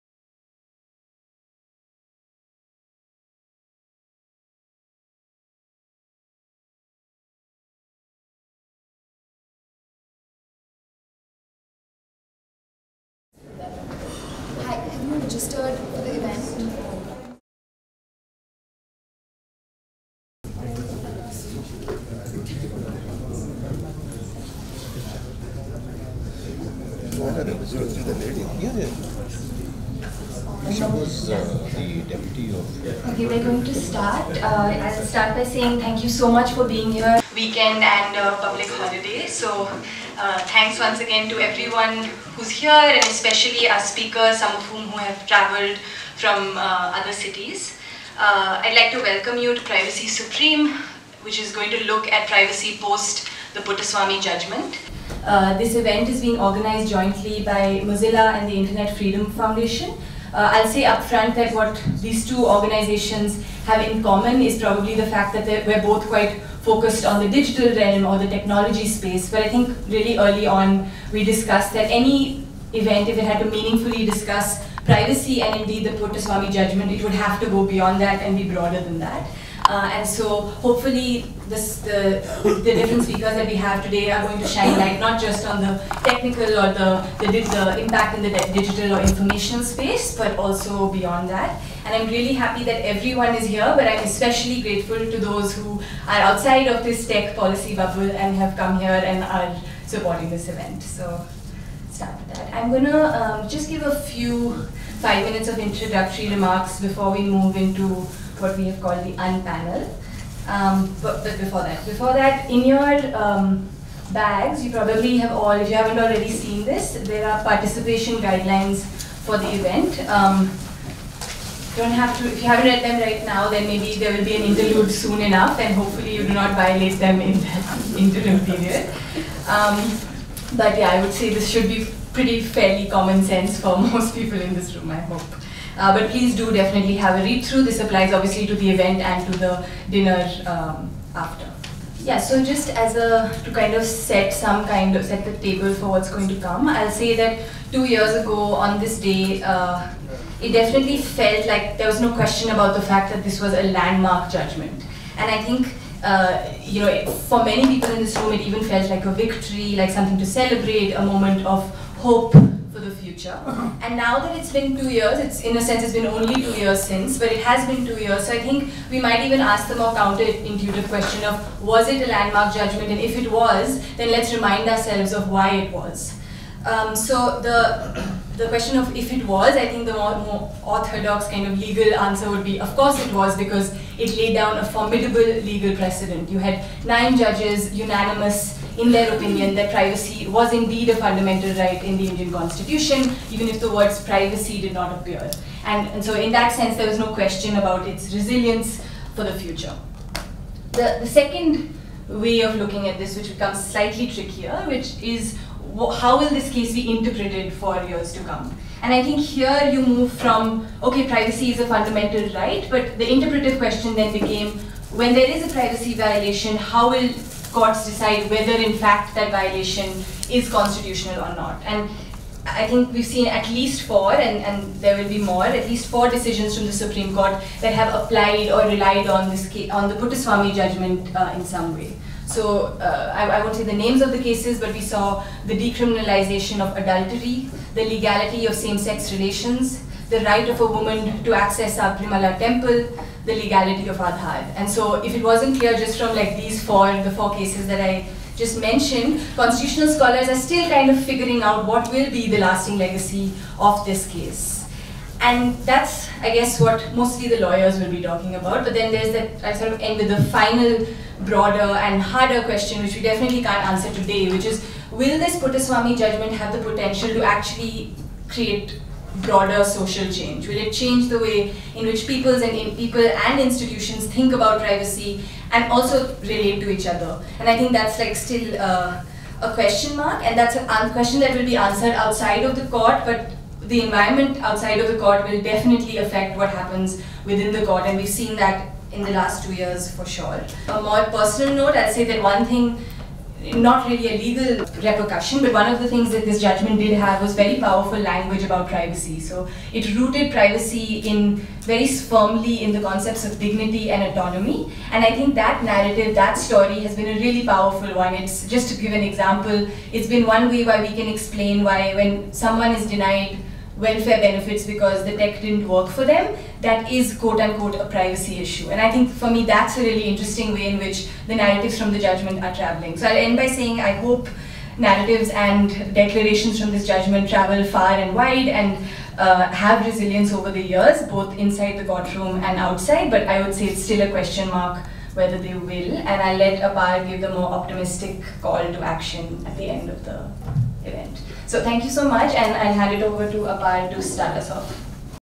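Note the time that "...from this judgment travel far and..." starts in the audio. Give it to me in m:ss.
5:26.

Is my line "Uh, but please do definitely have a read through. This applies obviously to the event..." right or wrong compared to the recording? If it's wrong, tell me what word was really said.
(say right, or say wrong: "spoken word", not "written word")
right.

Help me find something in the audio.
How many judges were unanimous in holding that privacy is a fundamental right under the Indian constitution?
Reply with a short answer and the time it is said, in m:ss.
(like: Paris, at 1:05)
9, at 3:06.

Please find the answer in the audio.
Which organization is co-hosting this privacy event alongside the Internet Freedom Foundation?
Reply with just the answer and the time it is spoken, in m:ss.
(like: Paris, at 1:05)
Mozilla, at 0:57.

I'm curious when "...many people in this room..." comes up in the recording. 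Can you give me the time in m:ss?
2:37.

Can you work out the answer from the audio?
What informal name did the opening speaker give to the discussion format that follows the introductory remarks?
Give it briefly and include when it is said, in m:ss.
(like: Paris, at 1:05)
unpanel, at 1:49.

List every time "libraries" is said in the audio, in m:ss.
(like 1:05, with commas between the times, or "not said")
not said.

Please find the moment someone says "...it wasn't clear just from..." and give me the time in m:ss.
4:05.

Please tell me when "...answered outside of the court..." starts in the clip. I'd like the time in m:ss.
4:41.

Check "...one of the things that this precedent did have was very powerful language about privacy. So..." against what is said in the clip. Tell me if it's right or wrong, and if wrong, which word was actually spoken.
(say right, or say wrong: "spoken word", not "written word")
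wrong: "judgment", not "precedent".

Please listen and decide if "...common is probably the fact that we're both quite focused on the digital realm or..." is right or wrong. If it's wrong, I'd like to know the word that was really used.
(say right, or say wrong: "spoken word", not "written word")
right.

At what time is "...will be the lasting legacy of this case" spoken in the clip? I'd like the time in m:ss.
4:11.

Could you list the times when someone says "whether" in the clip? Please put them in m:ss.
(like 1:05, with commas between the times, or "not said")
3:38, 5:35.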